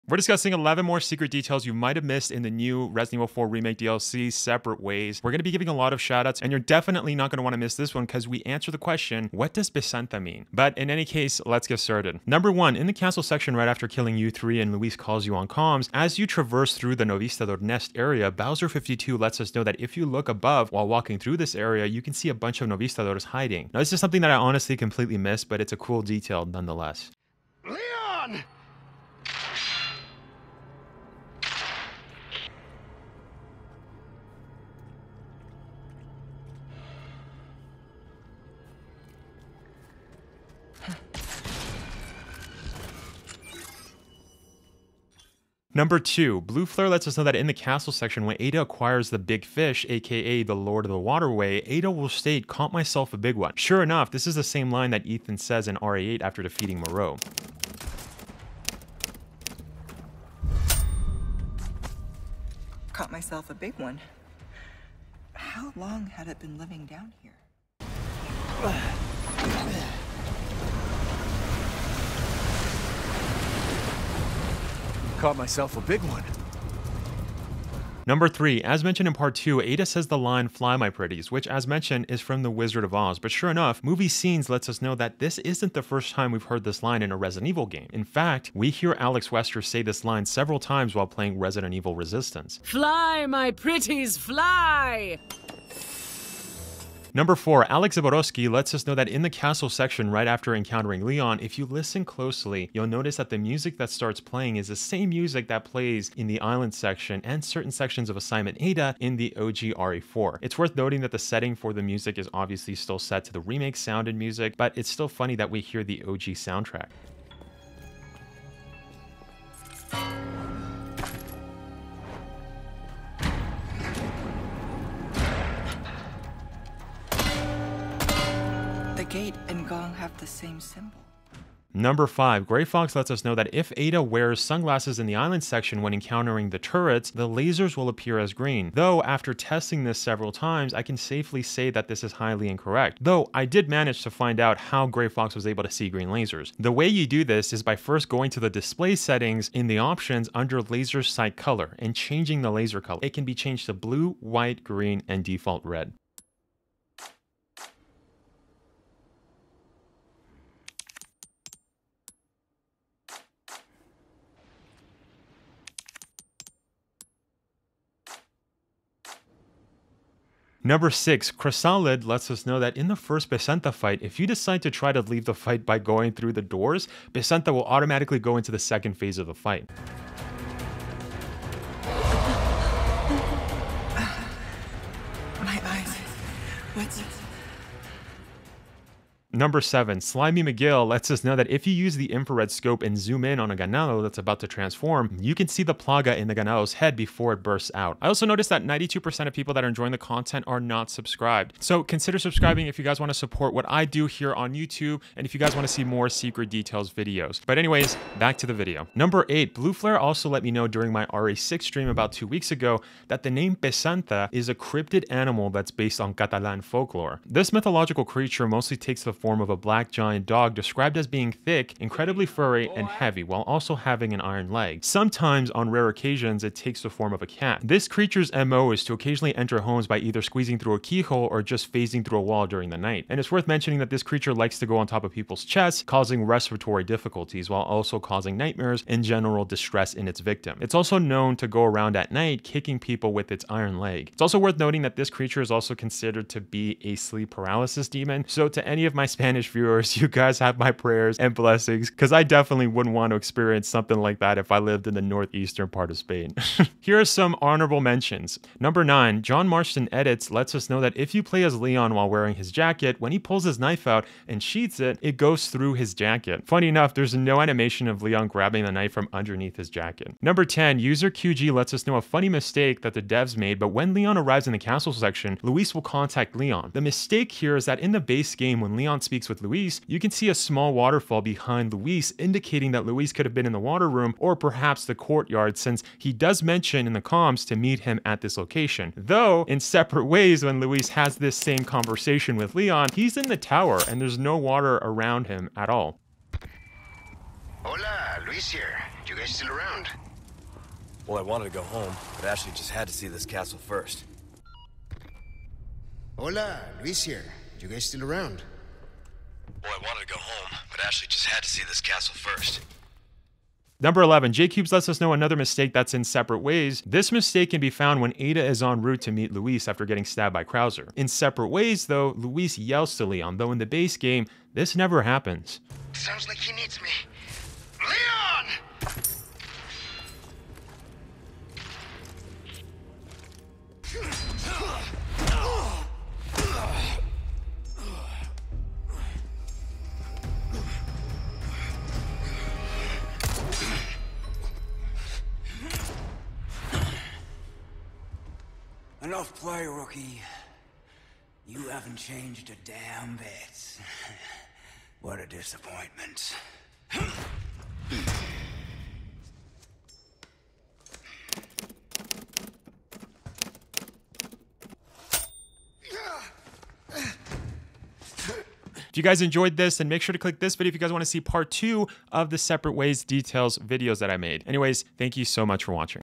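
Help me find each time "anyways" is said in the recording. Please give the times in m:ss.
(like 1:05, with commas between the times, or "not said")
3:27, 6:14.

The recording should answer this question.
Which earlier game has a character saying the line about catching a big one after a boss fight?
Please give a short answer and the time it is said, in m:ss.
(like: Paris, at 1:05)
RE8, at 0:55.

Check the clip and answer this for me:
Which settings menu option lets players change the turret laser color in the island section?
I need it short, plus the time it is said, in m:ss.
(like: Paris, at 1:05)
laser sight color, at 2:30.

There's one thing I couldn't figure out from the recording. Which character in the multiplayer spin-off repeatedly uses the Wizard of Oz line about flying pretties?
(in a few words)
Alex Wesker.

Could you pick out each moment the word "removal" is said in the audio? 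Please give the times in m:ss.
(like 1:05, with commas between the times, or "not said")
not said.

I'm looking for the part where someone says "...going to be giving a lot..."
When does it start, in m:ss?
0:05.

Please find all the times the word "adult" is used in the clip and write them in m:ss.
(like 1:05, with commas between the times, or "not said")
not said.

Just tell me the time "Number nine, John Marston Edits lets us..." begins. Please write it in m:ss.
4:18.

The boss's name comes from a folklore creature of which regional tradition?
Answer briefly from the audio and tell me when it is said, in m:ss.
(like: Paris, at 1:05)
Catalan, at 3:36.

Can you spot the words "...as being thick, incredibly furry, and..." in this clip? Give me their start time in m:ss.
3:40.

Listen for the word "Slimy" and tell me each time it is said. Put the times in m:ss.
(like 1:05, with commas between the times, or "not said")
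3:10.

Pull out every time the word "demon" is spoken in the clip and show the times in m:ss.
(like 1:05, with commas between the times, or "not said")
4:07.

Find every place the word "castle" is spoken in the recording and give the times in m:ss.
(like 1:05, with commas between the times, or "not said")
0:12, 0:47, 1:39, 4:34, 5:03, 5:11.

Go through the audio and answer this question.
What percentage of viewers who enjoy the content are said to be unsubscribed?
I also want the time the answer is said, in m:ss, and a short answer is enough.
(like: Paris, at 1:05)
92%, at 3:18.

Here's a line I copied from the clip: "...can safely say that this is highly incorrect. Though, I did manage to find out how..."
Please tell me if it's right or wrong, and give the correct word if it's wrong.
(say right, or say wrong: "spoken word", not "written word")
right.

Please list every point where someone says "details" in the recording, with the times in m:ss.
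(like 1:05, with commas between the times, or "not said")
0:01, 0:26, 3:26, 6:13.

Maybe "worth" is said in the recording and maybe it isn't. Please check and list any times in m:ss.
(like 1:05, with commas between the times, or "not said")
1:50, 3:53, 4:04.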